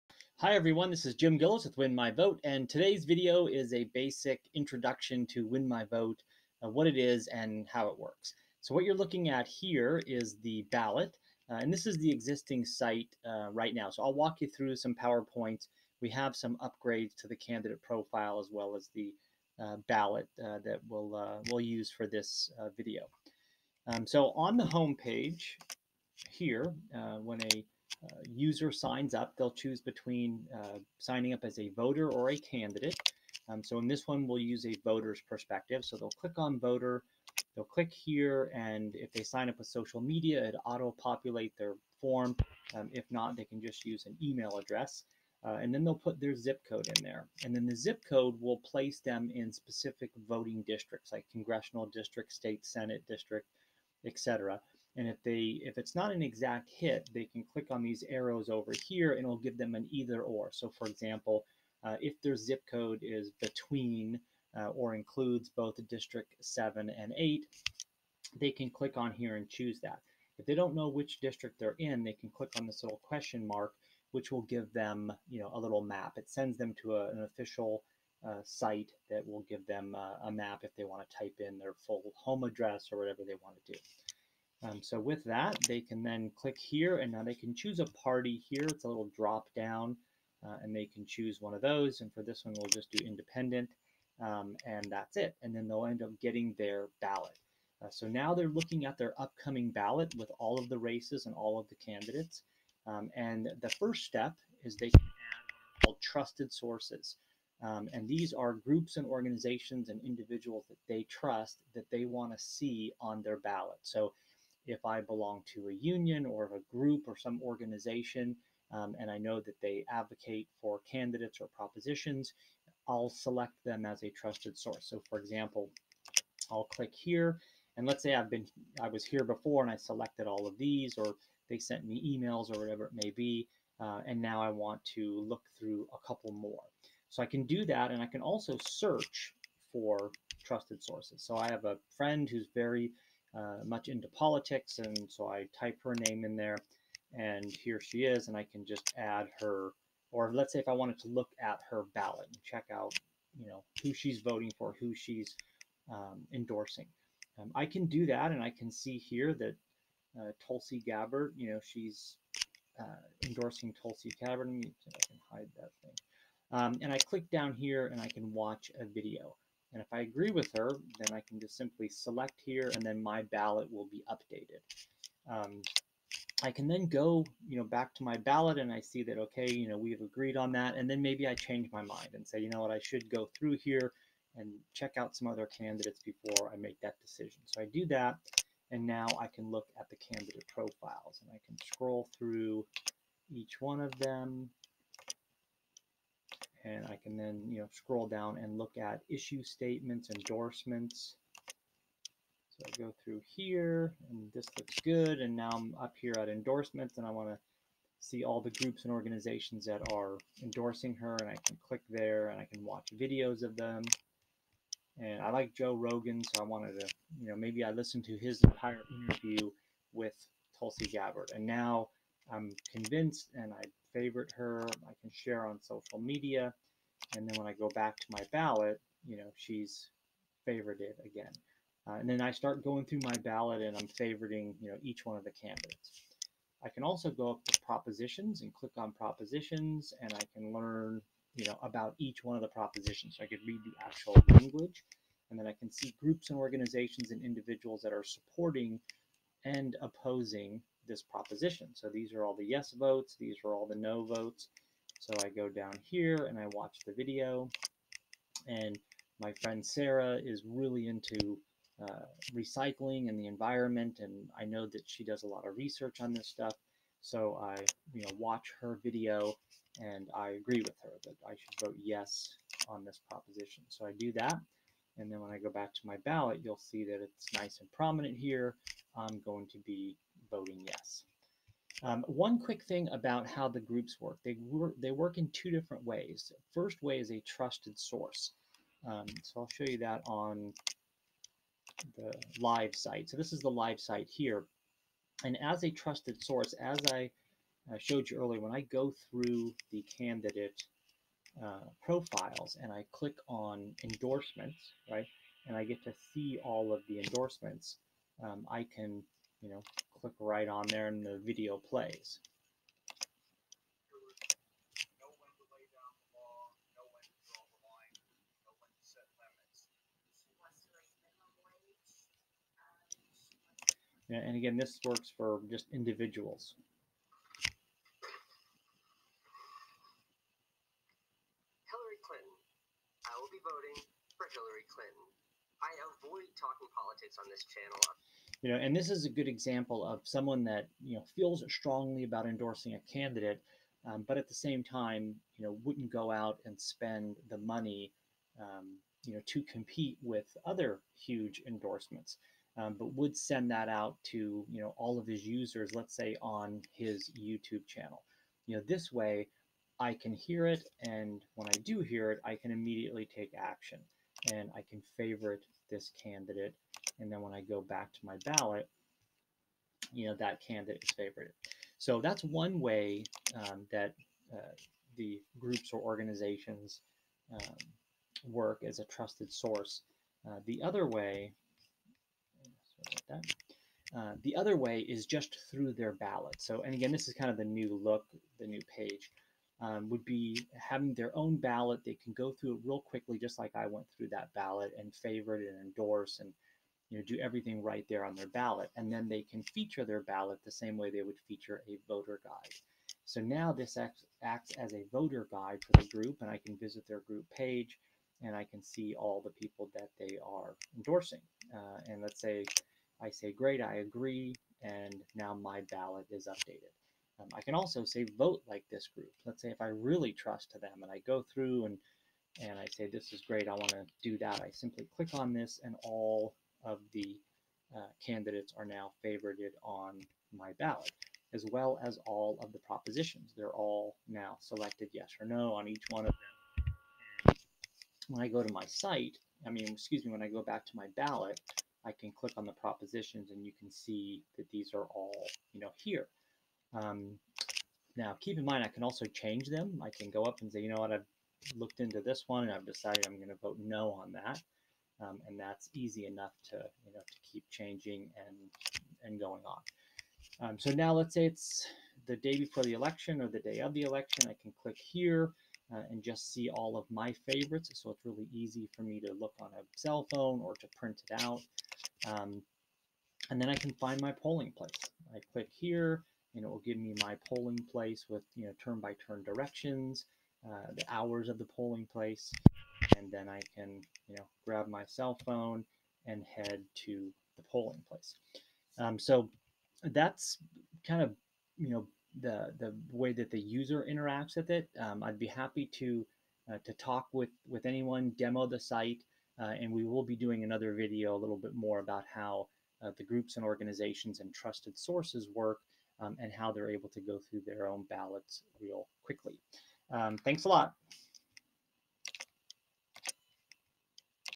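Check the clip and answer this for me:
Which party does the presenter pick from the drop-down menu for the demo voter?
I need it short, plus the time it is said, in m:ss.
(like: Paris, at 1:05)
Independent, at 1:33.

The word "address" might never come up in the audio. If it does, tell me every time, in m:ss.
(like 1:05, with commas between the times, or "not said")
0:44, 1:22.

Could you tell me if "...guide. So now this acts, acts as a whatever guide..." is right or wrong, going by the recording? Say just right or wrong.
wrong.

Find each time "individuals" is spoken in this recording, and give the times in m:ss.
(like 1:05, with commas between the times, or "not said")
1:50, 4:07, 5:25.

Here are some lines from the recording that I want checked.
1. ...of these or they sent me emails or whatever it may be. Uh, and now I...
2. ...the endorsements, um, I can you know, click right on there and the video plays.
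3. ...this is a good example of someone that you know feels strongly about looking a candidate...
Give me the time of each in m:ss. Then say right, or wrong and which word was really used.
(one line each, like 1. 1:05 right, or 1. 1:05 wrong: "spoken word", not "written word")
1. 2:10 right
2. 5:06 right
3. 5:38 wrong: "endorsing", not "looking".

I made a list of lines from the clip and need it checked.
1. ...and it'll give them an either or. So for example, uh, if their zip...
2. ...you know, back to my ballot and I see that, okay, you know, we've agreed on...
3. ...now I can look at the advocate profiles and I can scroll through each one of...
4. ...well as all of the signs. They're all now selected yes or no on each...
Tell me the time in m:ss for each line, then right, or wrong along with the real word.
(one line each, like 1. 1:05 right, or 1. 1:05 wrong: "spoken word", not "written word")
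1. 0:59 right
2. 2:57 right
3. 3:08 wrong: "candidate", not "advocate"
4. 7:11 wrong: "propositions", not "signs".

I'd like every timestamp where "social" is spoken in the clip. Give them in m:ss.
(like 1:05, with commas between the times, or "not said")
0:39, 3:45.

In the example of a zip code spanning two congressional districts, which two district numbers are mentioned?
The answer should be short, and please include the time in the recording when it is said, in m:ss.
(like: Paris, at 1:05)
7 and 8, at 1:05.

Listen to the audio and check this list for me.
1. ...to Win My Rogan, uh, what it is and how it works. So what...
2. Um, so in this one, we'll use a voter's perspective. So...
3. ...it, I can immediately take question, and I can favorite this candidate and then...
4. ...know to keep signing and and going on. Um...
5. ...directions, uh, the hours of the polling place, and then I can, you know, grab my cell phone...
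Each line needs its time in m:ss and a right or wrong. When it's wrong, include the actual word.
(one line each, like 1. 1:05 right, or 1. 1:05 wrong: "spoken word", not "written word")
1. 0:05 wrong: "Vote", not "Rogan"
2. 0:33 right
3. 6:02 wrong: "action", not "question"
4. 7:36 wrong: "changing", not "signing"
5. 7:59 right.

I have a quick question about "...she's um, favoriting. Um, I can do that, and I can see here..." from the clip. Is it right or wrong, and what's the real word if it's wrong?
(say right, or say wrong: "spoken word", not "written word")
wrong: "endorsing", not "favoriting".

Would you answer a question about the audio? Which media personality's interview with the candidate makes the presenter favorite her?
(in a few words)
Joe Rogan.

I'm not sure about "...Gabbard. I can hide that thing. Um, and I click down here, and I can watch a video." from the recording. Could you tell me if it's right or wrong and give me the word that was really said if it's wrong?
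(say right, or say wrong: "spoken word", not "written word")
right.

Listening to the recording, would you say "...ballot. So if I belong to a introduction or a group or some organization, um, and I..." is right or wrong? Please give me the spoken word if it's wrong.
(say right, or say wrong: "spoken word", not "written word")
wrong: "union", not "introduction".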